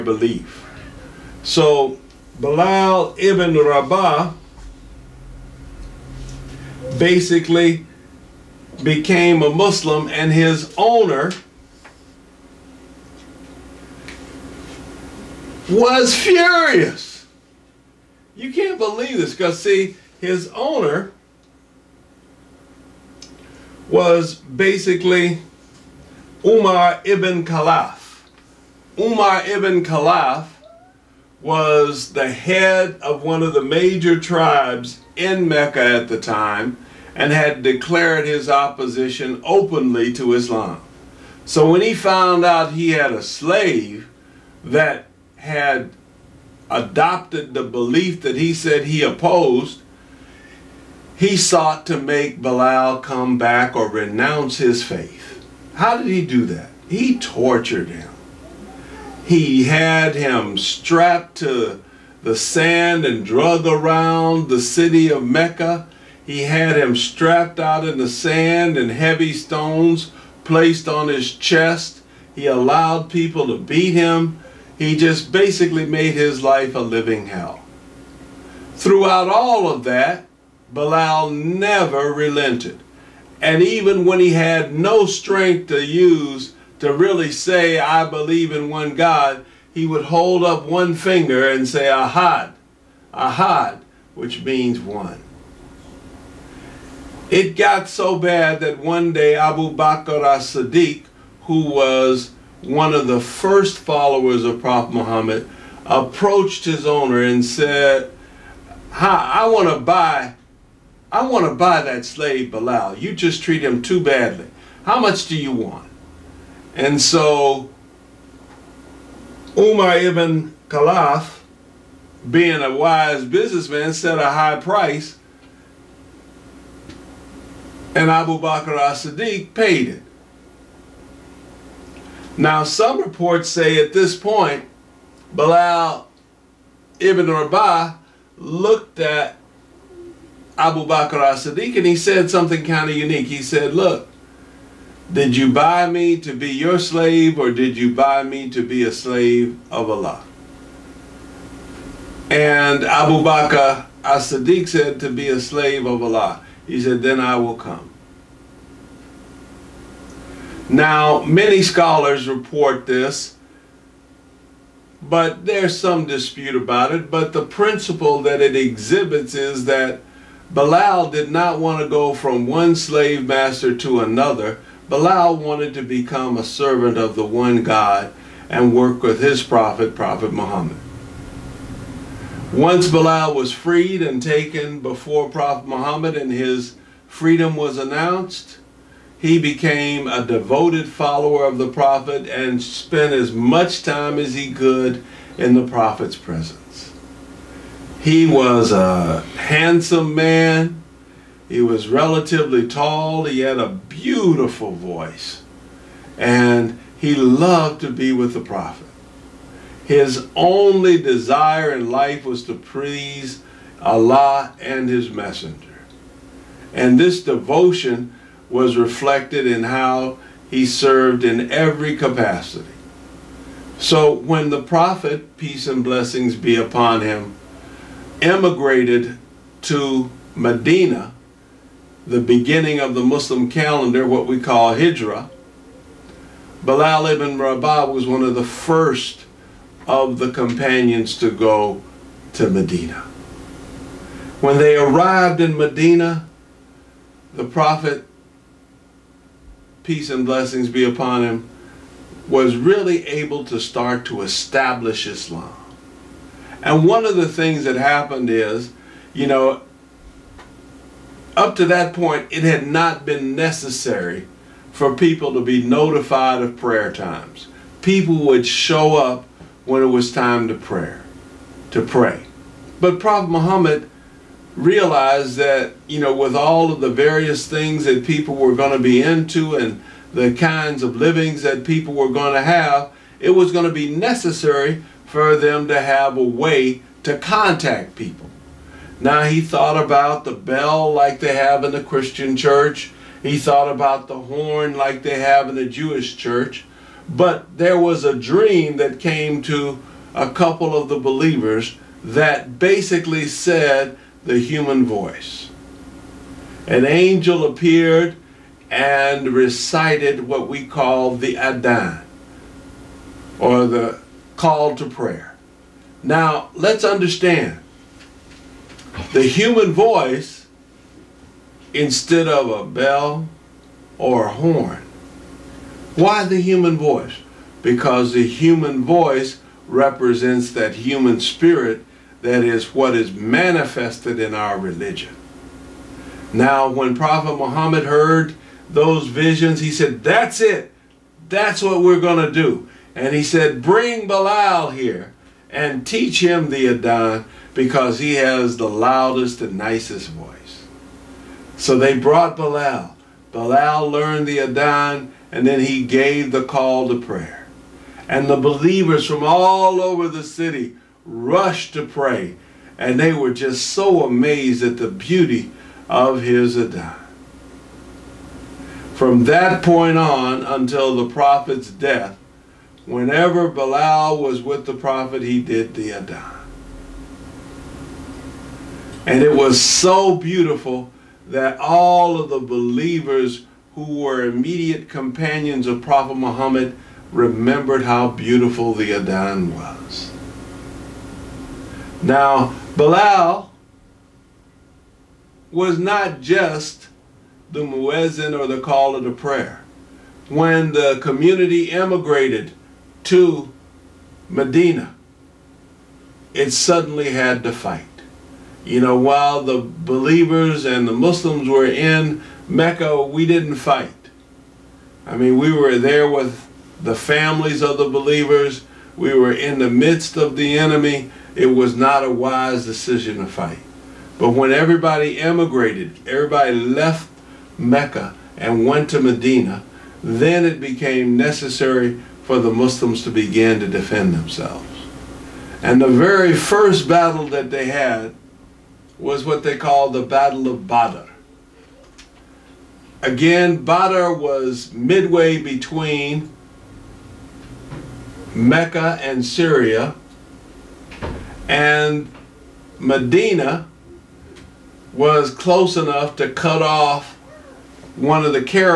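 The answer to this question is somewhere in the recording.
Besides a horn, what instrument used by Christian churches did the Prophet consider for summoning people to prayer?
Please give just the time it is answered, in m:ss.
4:50.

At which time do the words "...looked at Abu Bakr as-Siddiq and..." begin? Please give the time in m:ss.
2:18.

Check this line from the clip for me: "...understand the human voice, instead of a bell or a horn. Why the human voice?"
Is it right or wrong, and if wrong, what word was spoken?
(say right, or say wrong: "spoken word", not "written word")
right.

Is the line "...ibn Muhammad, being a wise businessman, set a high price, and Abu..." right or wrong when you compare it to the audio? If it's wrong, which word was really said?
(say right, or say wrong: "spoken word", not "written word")
wrong: "Khalaf", not "Muhammad".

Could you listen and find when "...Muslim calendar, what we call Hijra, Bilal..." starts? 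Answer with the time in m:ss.
3:53.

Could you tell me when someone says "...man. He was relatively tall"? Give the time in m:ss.
3:20.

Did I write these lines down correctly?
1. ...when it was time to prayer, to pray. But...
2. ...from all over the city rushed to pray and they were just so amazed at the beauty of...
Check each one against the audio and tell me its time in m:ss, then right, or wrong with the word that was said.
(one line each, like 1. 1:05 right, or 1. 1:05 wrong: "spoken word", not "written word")
1. 4:29 right
2. 5:59 right.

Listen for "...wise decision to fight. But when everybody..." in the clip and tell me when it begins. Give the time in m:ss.
7:02.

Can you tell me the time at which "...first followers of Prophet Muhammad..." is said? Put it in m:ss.
1:43.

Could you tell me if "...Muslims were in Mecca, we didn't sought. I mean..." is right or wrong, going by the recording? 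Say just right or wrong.
wrong.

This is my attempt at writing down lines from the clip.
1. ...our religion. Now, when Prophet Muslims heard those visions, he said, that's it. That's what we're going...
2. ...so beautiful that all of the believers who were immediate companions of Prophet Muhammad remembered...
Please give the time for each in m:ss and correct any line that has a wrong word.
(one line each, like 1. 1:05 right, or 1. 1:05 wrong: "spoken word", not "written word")
1. 5:34 wrong: "Muhammad", not "Muslims"
2. 6:19 right.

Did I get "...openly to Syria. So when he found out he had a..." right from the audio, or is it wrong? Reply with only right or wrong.
wrong.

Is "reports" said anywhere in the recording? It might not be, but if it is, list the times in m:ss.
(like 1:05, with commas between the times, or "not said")
2:13, 2:42.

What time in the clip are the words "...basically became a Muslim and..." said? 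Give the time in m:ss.
0:06.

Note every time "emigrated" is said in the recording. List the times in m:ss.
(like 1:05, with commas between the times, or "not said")
3:48, 7:05.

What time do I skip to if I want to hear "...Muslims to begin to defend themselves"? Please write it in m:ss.
7:12.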